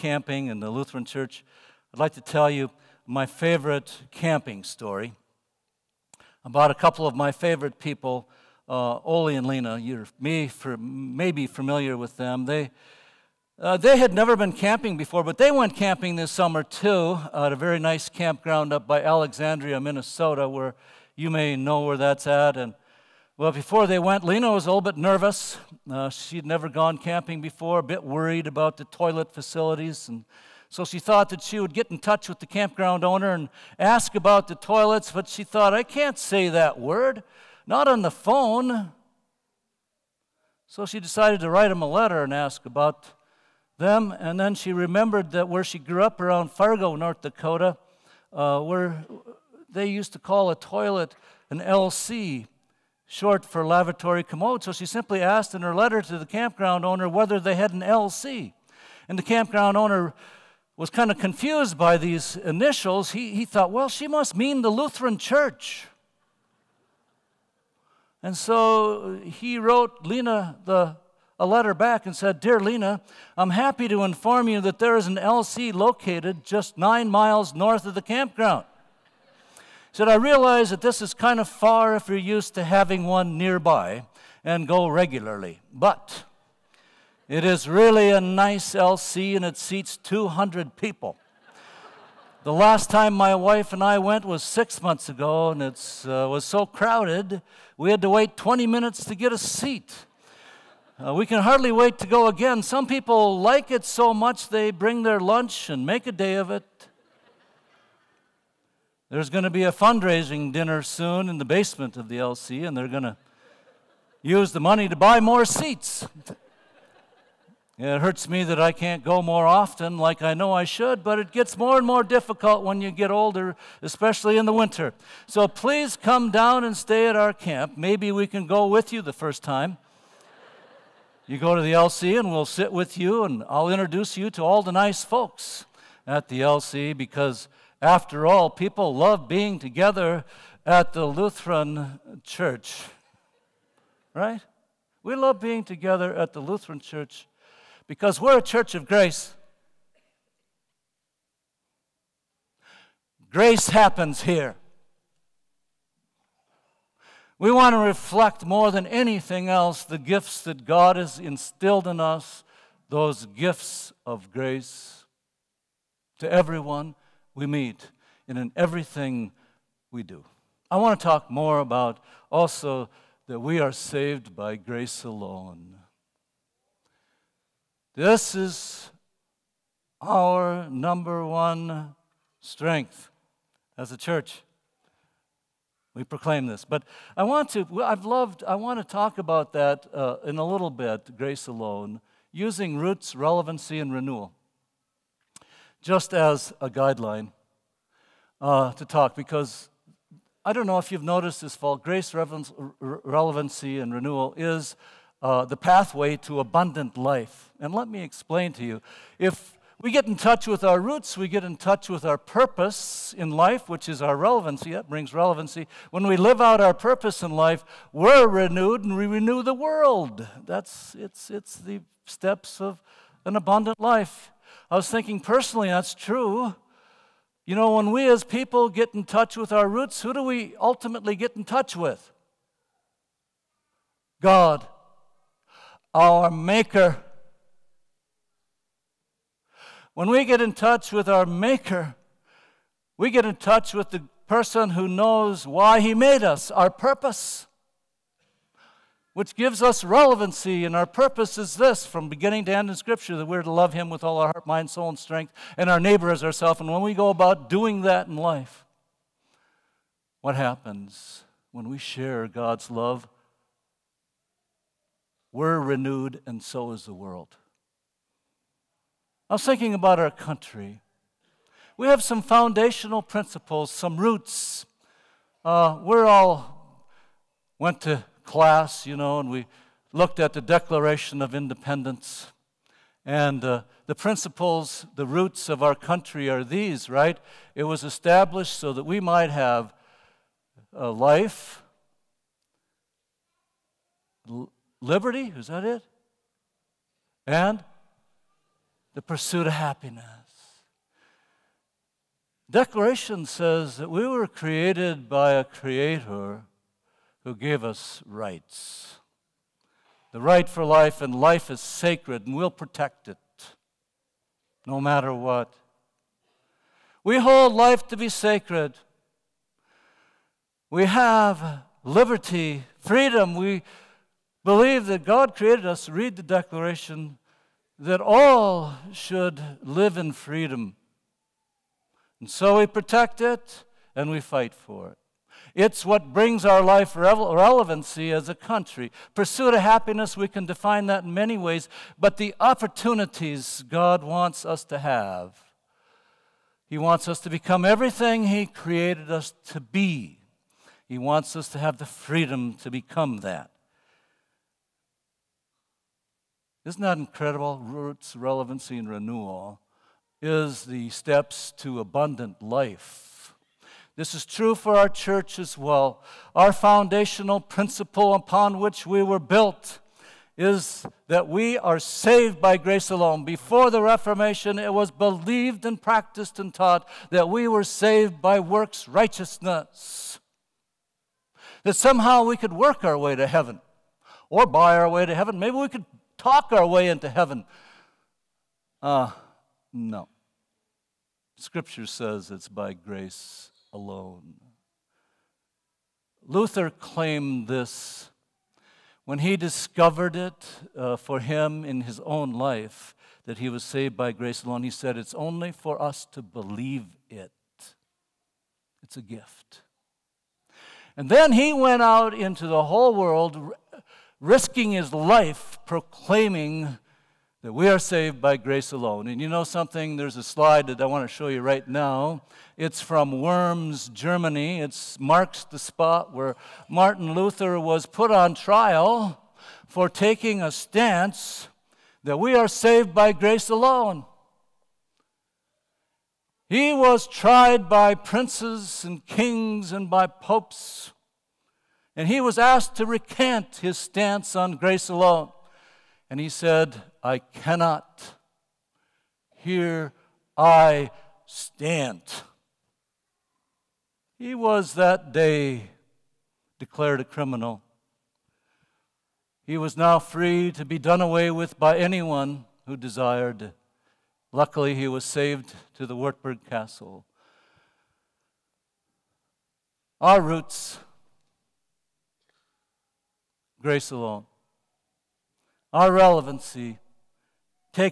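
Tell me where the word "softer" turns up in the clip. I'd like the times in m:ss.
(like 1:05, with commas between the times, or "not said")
not said.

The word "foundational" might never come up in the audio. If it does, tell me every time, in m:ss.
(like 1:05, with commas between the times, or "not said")
4:32, 6:06.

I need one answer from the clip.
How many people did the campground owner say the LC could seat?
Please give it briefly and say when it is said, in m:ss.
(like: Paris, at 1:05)
200, at 1:29.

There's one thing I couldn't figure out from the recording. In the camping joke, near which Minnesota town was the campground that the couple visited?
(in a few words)
Alexandria.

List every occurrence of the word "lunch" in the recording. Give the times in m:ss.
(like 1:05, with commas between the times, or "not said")
1:45.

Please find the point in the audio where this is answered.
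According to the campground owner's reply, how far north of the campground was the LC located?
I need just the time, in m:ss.
1:16.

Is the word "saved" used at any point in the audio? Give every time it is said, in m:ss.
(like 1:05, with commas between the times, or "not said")
2:53, 6:11, 6:17, 6:43, 6:57, 7:12, 7:45.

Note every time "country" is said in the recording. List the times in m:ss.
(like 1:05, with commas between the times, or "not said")
4:30, 4:45, 5:38.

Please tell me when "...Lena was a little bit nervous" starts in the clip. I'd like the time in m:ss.
0:24.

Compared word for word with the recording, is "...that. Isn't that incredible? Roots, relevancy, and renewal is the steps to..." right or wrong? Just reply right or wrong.
right.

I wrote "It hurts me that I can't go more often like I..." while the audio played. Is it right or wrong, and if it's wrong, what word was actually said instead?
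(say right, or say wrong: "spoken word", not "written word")
right.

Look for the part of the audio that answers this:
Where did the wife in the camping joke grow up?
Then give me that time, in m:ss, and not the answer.
0:46.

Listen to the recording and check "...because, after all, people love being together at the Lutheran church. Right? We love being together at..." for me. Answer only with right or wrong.
right.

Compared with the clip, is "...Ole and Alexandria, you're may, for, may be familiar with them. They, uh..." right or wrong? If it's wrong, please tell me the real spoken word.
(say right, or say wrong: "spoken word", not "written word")
wrong: "Lena", not "Alexandria".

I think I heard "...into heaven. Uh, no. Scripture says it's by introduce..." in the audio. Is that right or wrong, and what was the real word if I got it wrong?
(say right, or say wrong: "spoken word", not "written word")
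wrong: "grace", not "introduce".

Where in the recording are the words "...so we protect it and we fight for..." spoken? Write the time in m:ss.
5:32.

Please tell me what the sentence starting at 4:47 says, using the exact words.
It was established so that we might have life, liberty, is that it?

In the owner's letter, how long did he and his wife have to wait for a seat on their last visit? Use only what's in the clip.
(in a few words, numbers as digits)
20 minutes.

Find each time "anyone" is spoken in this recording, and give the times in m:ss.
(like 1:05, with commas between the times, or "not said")
7:41.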